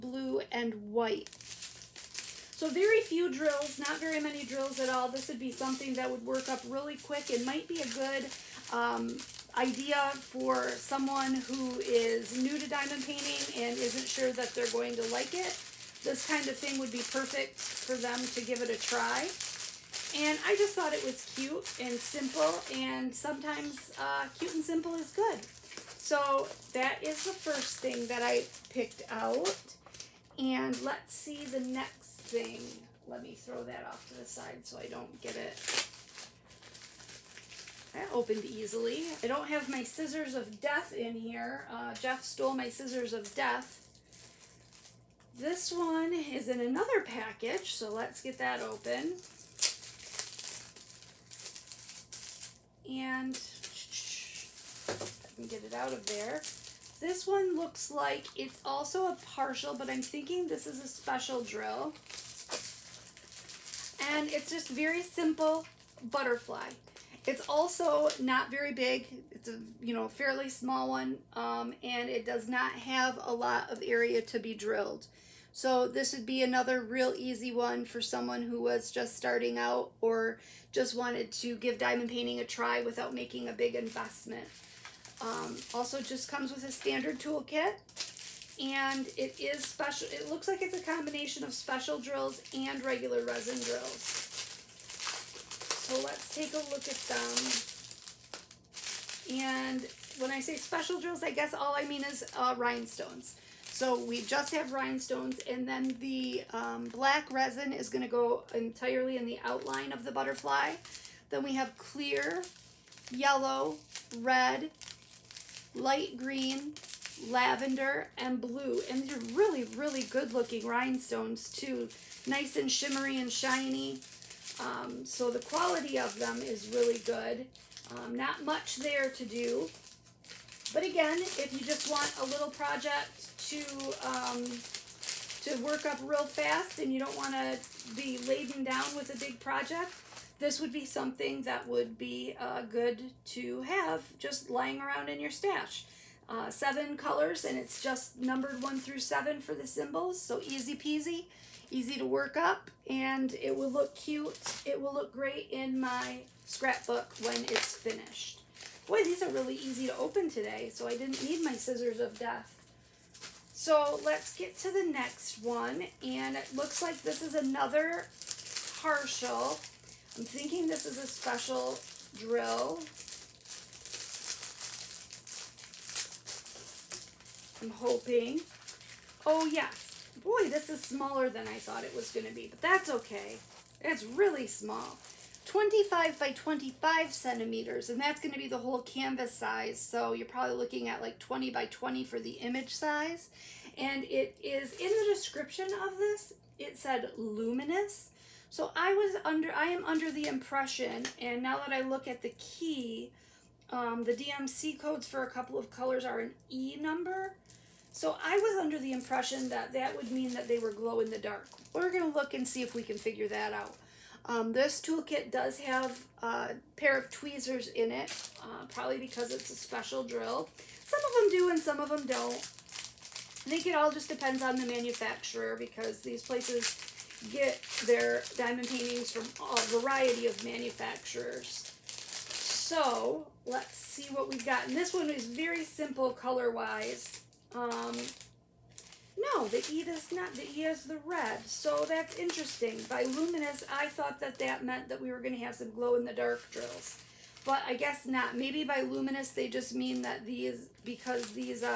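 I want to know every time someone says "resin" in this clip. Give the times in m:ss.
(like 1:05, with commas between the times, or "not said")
1:33, 1:47.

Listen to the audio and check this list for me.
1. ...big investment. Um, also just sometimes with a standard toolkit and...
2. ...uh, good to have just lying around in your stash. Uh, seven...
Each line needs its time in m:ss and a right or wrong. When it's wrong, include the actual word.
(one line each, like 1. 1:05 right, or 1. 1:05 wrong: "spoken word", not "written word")
1. 1:23 wrong: "comes", not "sometimes"
2. 2:22 right.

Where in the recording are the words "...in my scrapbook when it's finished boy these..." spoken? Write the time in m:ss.
2:35.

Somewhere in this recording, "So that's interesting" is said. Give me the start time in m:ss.
4:01.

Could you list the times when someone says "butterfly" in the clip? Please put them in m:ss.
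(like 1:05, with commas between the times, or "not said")
1:06, 1:50.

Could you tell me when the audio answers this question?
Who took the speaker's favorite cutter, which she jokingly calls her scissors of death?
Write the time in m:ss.
0:41.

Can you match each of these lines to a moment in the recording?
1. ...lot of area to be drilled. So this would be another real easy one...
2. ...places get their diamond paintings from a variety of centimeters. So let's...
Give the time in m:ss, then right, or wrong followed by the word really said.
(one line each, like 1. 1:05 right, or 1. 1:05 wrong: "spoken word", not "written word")
1. 1:13 right
2. 3:46 wrong: "manufacturers", not "centimeters".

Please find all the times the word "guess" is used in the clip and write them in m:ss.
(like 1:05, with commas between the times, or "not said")
1:41, 4:07.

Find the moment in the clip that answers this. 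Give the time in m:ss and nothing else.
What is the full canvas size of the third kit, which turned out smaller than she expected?
3:05.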